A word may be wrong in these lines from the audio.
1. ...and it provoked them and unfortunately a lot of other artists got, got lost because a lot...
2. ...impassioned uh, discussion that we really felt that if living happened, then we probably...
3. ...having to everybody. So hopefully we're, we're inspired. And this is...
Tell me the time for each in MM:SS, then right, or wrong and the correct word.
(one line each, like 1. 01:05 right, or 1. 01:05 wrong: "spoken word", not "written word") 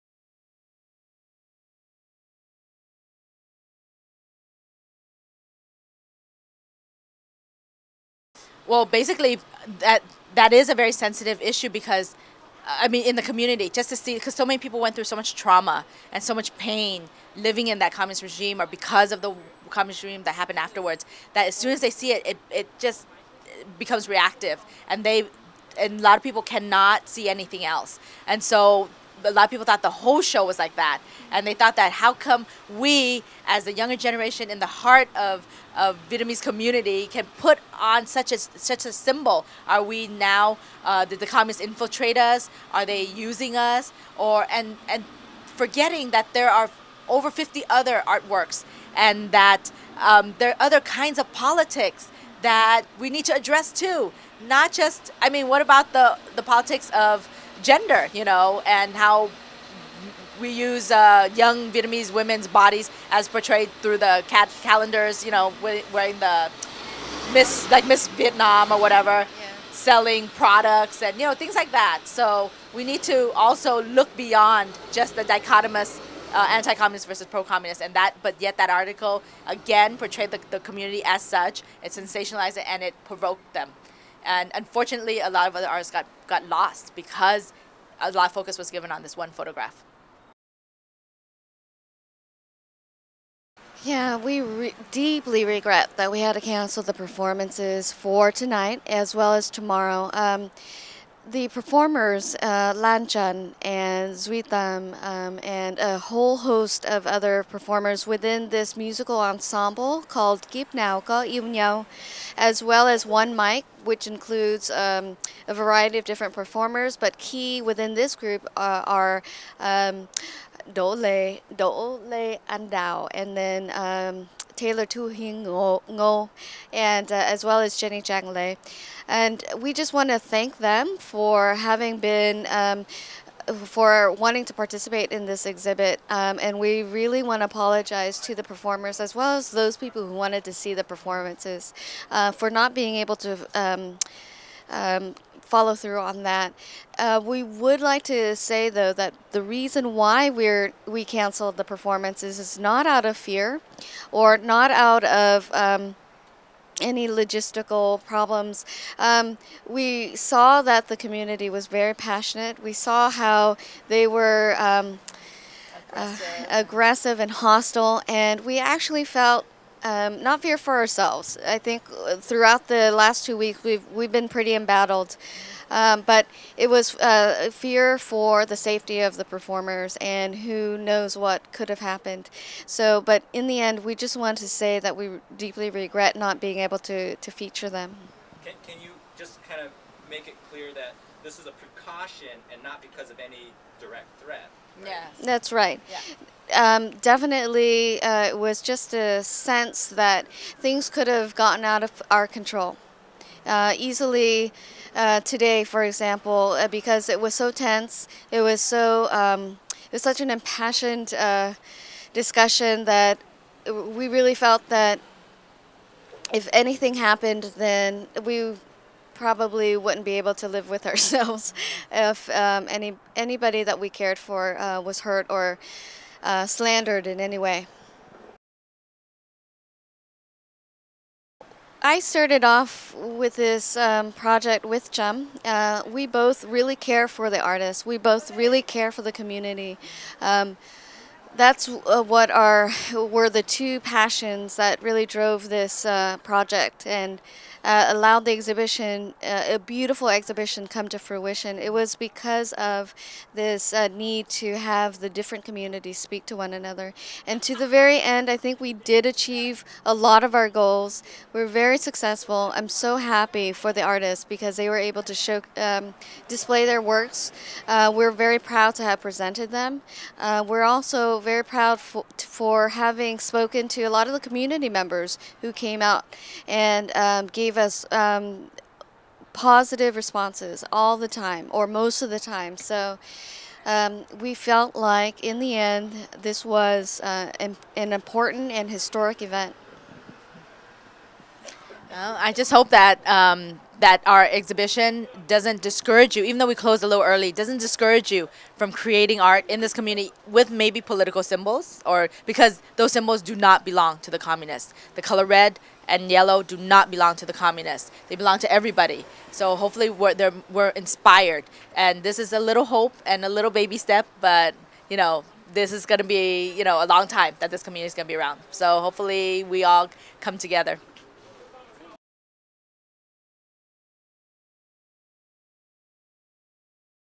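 1. 01:22 right
2. 03:30 wrong: "anything", not "living"
3. 05:08 wrong: "belong", not "having".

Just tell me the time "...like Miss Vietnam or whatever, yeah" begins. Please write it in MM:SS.
01:07.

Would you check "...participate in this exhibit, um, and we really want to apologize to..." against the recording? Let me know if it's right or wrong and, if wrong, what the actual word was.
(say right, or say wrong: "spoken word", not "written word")
right.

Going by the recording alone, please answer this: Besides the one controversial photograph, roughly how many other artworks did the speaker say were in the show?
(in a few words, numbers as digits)
over 50.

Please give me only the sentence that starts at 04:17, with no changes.
And to the very end, I think we did achieve a lot of our goals.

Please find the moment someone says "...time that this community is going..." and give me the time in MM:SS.
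05:17.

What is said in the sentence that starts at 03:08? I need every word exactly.
Can, can you just kind of make it clear that this is a precaution and not because of any direct threat?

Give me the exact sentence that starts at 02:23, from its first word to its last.
Um, um follow through on that.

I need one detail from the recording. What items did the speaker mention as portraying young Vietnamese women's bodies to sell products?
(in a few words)
cat calendars.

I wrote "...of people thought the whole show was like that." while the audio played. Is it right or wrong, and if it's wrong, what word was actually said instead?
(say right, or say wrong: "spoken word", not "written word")
right.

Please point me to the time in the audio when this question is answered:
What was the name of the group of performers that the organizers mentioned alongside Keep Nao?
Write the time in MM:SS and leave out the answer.
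01:53.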